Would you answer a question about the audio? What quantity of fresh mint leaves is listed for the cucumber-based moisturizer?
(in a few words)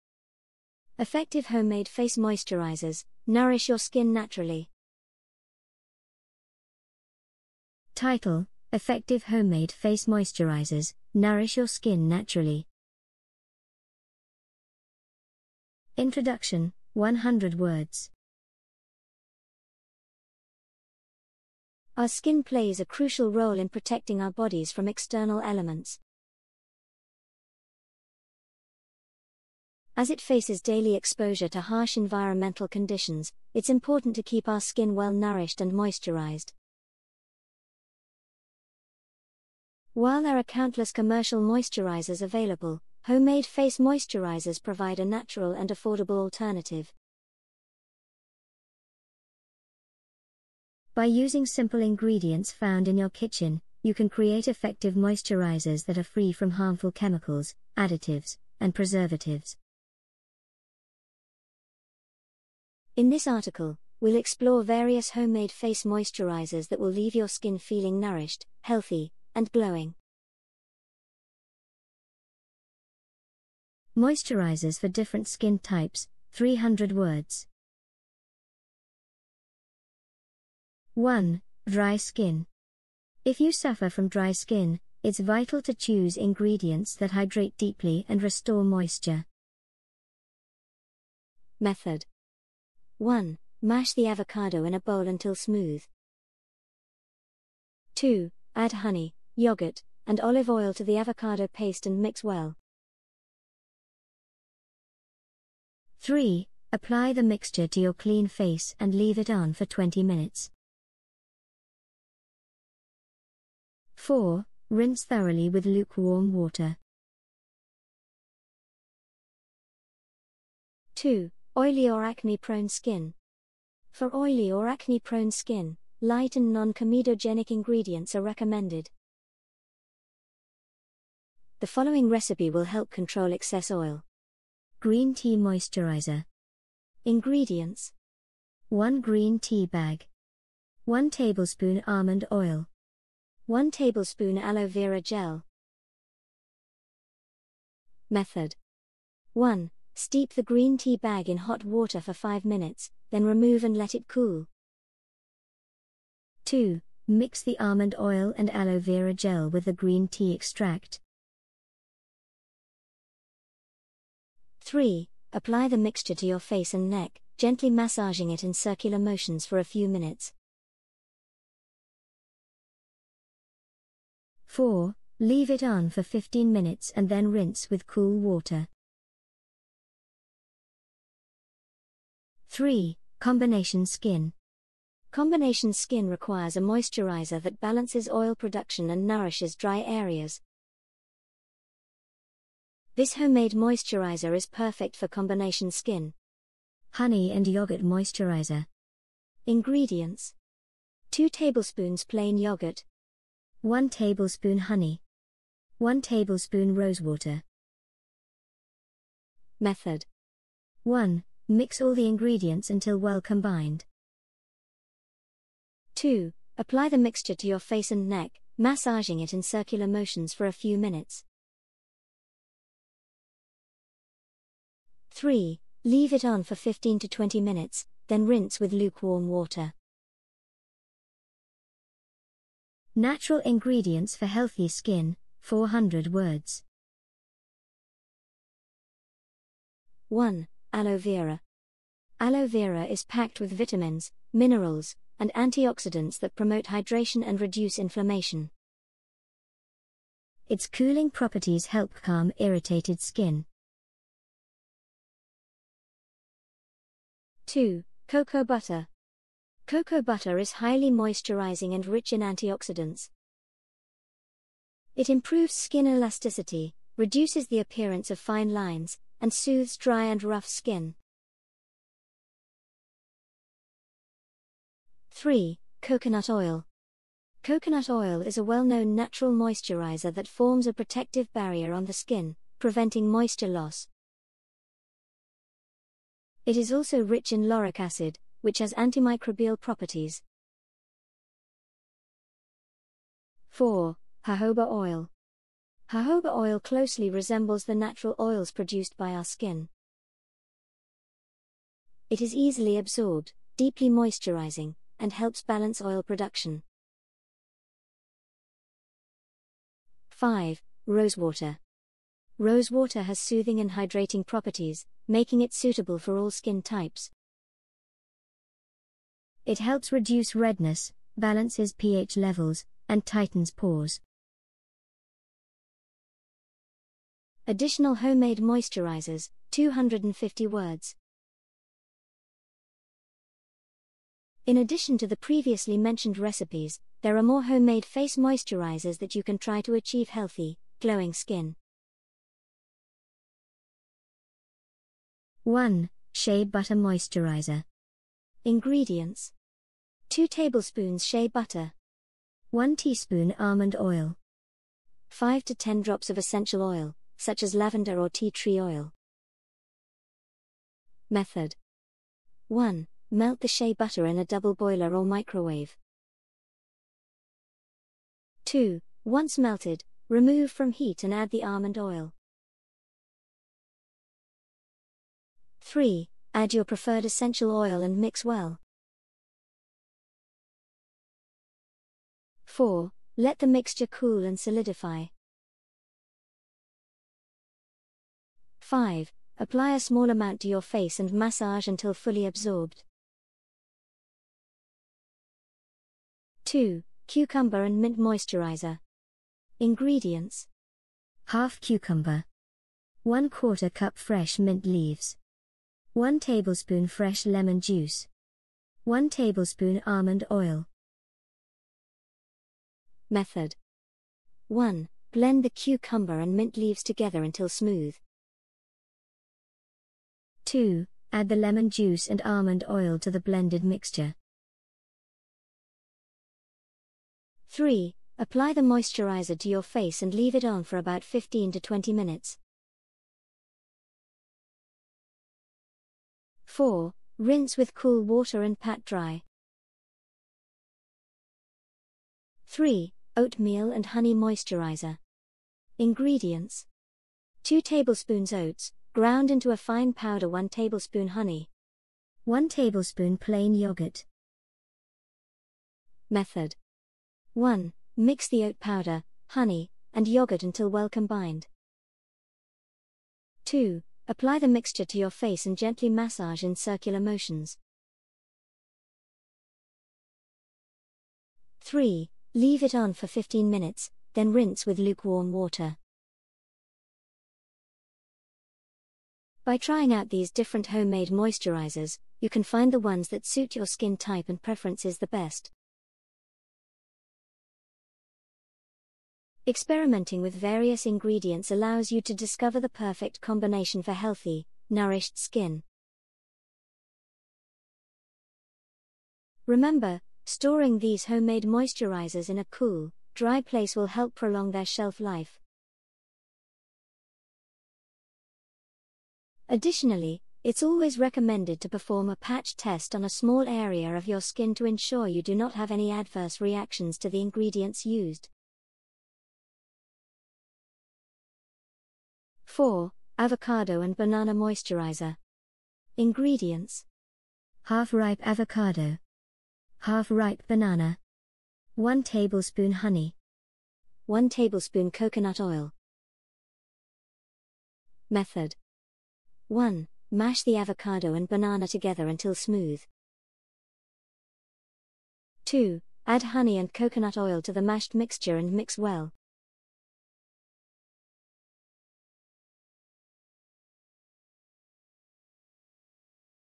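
1/4 cup.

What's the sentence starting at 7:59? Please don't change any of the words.
By trying out these different homemade moisturizers, you can find the ones that suit your skin type and preferences the best.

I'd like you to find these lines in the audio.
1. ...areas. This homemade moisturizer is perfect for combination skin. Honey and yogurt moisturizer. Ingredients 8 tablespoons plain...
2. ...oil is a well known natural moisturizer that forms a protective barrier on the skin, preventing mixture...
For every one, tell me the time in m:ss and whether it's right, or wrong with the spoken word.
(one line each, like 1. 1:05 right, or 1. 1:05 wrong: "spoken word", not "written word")
1. 3:09 wrong: "2", not "8"
2. 4:37 wrong: "moisture", not "mixture".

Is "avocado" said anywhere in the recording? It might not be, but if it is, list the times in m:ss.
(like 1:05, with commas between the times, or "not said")
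1:34, 1:40, 8:43, 8:48, 9:00.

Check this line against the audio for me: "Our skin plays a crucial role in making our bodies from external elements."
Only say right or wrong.
wrong.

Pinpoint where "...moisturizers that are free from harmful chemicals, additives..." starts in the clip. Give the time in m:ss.
0:54.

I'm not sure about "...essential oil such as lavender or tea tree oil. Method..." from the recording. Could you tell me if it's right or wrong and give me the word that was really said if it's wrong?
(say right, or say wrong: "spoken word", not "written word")
right.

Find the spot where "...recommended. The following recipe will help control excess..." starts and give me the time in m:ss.
2:08.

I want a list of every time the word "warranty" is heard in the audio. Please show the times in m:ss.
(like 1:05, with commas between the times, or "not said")
not said.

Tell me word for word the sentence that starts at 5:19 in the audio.
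It helps reduce redness, balances pH levels, and tightens pores.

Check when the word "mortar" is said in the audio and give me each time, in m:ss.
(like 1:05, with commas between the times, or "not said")
not said.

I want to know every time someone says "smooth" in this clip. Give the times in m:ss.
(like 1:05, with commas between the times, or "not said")
1:35, 6:57, 9:02.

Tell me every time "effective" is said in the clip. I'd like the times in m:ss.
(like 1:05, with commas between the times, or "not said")
0:01, 0:08, 0:54.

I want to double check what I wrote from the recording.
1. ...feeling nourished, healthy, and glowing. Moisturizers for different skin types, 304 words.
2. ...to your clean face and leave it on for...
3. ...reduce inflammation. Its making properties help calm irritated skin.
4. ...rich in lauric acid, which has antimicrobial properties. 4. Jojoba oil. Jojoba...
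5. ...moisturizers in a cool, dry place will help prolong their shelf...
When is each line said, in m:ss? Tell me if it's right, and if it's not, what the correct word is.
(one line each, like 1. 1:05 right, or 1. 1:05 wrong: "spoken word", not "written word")
1. 1:07 wrong: "300", not "304"
2. 1:47 right
3. 4:07 wrong: "cooling", not "making"
4. 4:47 right
5. 8:21 right.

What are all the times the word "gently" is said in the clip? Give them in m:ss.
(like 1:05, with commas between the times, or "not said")
2:47, 7:45.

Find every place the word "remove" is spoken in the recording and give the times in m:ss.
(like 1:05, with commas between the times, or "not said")
2:33, 6:10.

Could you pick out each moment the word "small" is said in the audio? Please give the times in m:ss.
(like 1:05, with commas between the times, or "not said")
6:29, 8:33.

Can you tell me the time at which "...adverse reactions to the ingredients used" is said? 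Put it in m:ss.
8:35.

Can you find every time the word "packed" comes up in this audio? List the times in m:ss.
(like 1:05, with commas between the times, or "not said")
4:03.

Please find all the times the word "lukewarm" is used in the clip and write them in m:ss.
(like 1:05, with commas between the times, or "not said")
1:55, 3:48, 7:54.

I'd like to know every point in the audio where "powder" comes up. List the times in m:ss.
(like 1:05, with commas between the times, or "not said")
7:29, 7:38.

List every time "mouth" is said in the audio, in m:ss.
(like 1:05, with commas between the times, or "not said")
not said.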